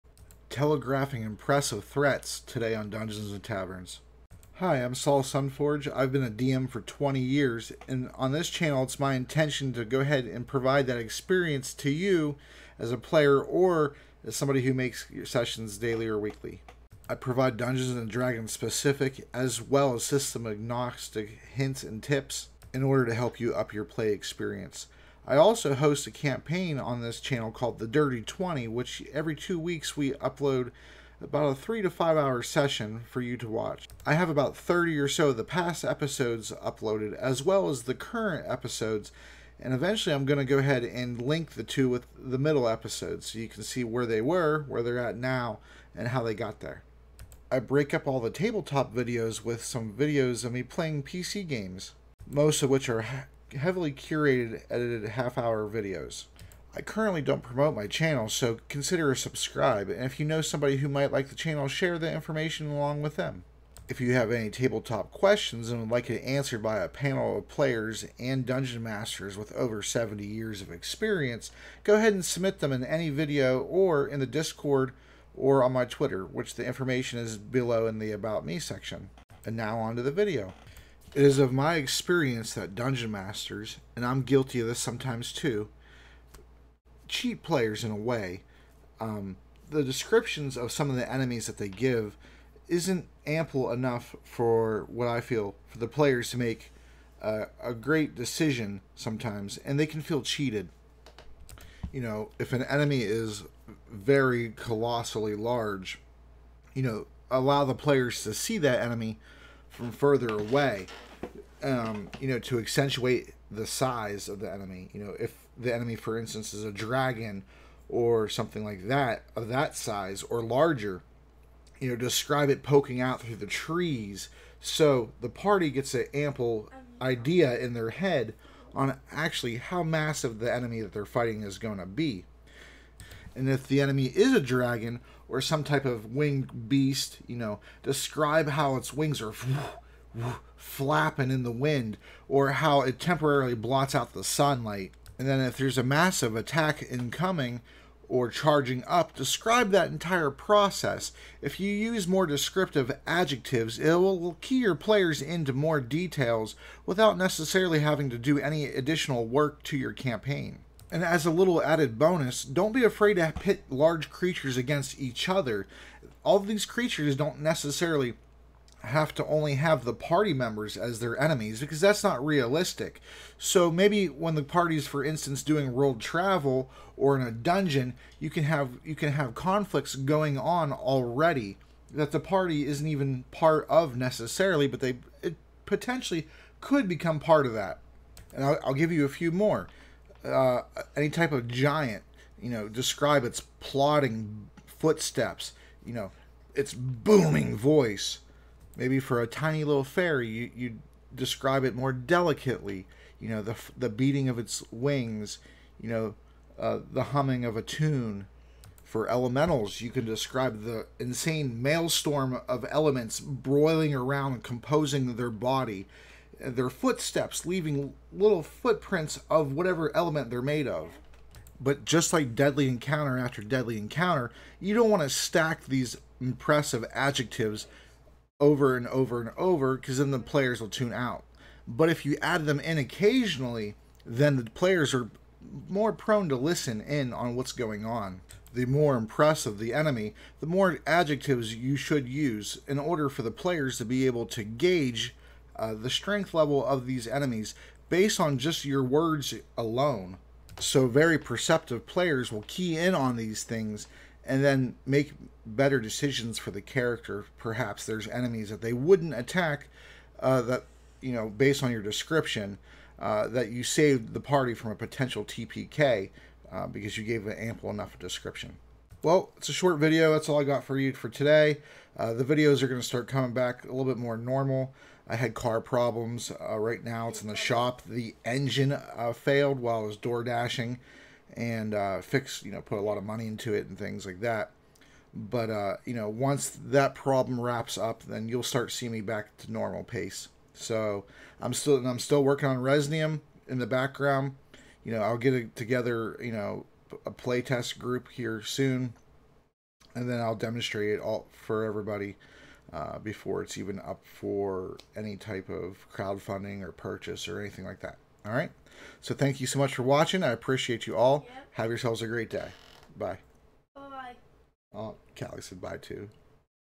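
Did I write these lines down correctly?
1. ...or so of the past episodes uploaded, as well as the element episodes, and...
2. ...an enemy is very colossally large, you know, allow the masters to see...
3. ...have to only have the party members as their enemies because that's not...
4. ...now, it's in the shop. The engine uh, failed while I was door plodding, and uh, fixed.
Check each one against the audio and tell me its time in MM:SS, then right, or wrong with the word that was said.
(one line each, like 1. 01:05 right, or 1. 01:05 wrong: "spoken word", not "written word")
1. 00:34 wrong: "current", not "element"
2. 01:42 wrong: "players", not "masters"
3. 02:48 right
4. 04:36 wrong: "dashing", not "plodding".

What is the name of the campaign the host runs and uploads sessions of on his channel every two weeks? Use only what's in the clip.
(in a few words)
The Dirty 20.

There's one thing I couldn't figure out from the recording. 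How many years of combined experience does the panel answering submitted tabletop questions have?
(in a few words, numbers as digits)
70.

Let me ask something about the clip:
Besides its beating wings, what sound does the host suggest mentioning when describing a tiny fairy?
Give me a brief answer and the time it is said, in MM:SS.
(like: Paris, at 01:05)
Humming of a tune, at 03:27.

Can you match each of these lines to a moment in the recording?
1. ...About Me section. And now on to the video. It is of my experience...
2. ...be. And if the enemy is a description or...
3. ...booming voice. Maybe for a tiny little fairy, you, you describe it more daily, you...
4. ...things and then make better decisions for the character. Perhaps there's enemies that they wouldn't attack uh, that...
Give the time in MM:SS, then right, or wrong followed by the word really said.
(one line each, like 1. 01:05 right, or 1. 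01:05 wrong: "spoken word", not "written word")
1. 01:18 right
2. 02:11 wrong: "dragon", not "description"
3. 03:16 wrong: "delicately", not "daily"
4. 04:13 right.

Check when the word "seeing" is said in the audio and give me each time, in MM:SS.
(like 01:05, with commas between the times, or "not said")
04:48.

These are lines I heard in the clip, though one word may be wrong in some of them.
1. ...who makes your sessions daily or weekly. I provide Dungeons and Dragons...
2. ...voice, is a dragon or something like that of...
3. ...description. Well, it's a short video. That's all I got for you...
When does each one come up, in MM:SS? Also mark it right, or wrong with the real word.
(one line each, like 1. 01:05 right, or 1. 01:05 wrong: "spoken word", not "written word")
1. 00:14 right
2. 01:56 wrong: "instance", not "voice"
3. 04:27 right.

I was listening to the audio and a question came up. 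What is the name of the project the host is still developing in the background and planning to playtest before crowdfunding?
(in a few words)
Resnium.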